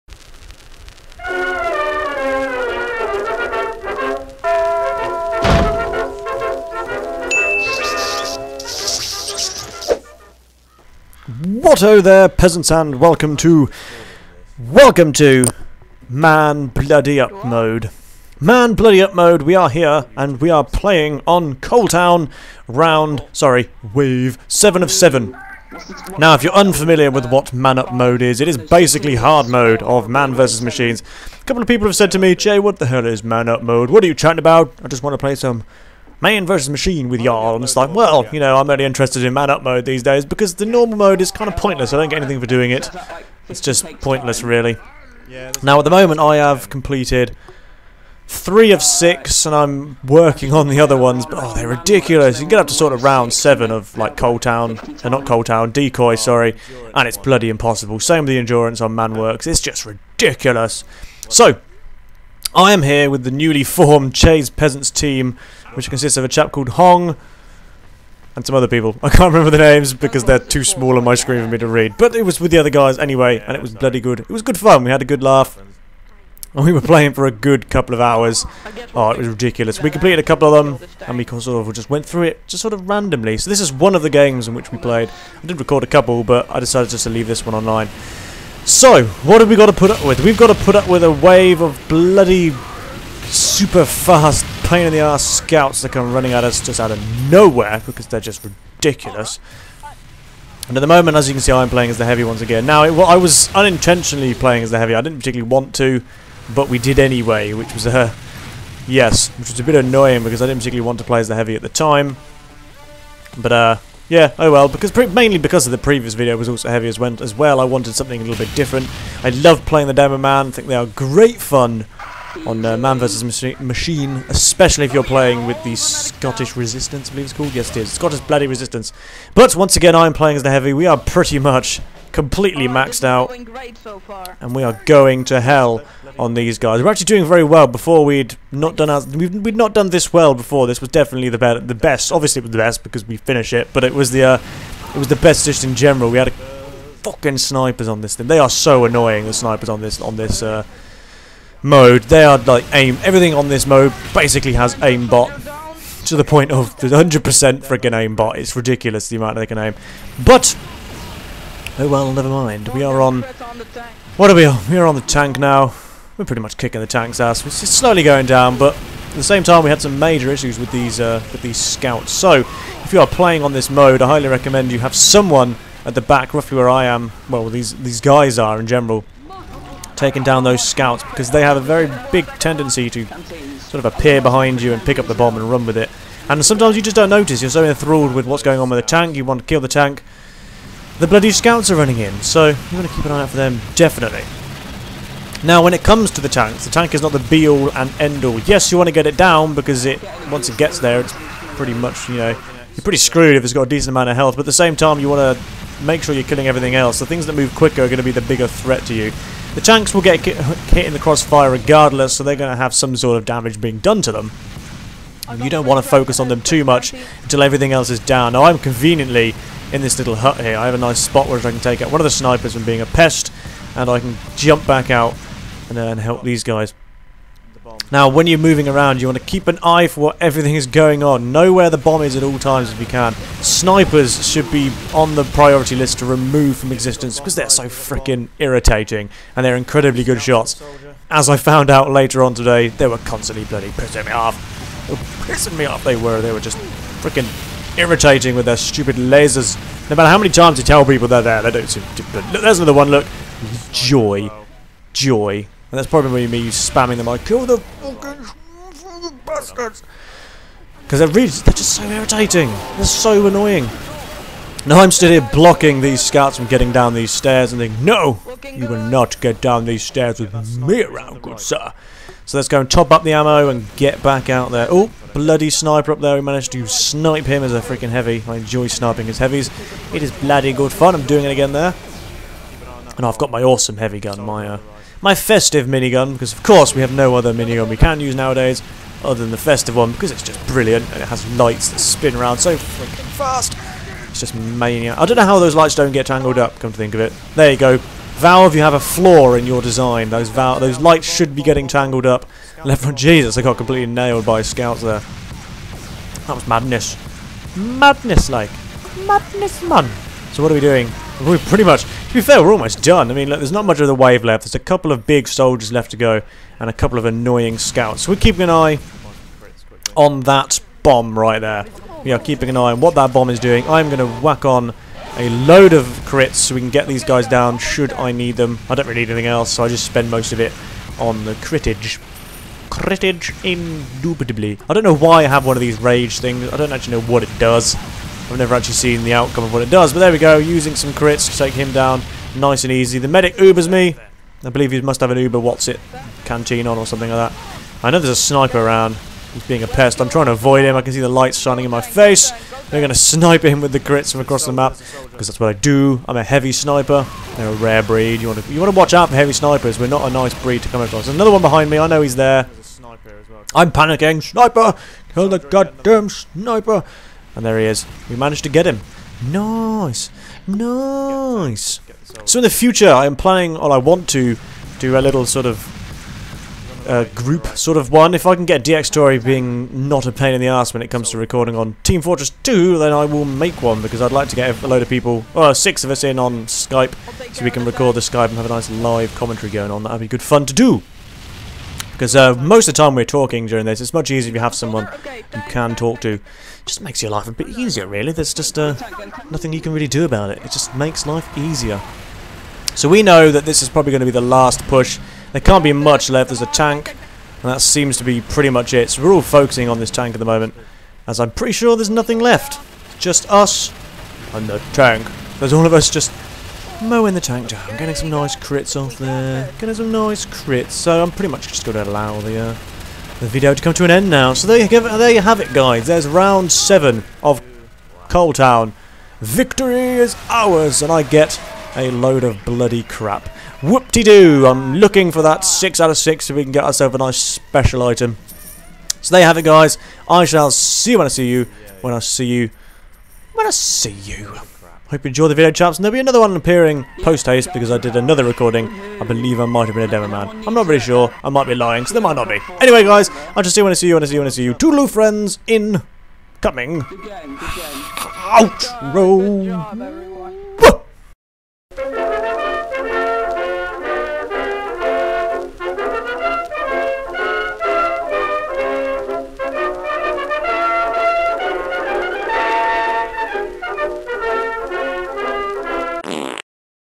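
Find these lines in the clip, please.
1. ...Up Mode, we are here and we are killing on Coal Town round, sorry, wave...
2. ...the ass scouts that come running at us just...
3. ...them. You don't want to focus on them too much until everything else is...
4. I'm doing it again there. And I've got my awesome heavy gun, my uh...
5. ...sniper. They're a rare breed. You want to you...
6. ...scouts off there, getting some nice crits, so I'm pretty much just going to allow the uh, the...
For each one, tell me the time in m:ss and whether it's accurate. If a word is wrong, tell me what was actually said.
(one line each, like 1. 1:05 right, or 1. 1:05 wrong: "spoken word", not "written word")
1. 0:19 wrong: "playing", not "killing"
2. 1:34 right
3. 3:34 right
4. 4:40 right
5. 5:56 right
6. 6:58 wrong: "crits", not "scouts".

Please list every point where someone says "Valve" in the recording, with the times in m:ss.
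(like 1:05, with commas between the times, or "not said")
4:58.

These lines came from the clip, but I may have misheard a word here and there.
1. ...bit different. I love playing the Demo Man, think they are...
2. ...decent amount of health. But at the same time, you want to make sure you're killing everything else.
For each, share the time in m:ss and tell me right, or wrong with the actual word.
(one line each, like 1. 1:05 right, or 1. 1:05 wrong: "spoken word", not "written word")
1. 1:58 right
2. 3:23 right.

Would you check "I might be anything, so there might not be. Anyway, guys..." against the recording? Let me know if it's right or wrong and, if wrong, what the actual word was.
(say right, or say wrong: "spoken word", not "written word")
wrong: "lying", not "anything".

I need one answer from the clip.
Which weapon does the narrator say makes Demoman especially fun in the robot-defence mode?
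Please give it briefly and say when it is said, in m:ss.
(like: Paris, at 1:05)
Scottish Resistance, at 2:05.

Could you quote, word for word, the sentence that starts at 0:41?
I don't get anything for doing it.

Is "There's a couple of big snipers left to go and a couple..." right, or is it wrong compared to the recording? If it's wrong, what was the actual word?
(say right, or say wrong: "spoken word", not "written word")
wrong: "soldiers", not "snipers".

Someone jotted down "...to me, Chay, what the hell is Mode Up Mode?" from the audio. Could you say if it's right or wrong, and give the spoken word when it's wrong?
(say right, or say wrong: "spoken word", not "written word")
wrong: "Mann", not "Mode".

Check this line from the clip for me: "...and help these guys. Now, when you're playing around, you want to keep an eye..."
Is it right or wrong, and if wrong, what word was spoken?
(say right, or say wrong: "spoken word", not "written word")
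wrong: "moving", not "playing".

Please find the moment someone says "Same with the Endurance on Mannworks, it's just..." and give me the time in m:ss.
0:57.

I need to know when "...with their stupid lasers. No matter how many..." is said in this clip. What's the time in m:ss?
4:08.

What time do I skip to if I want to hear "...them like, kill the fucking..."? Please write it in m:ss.
4:16.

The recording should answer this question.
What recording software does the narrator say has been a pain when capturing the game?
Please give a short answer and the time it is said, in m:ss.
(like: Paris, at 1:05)
Dxtory, at 6:18.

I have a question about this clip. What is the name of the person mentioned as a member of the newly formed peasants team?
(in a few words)
Hong.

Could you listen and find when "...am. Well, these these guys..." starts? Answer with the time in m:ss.
2:56.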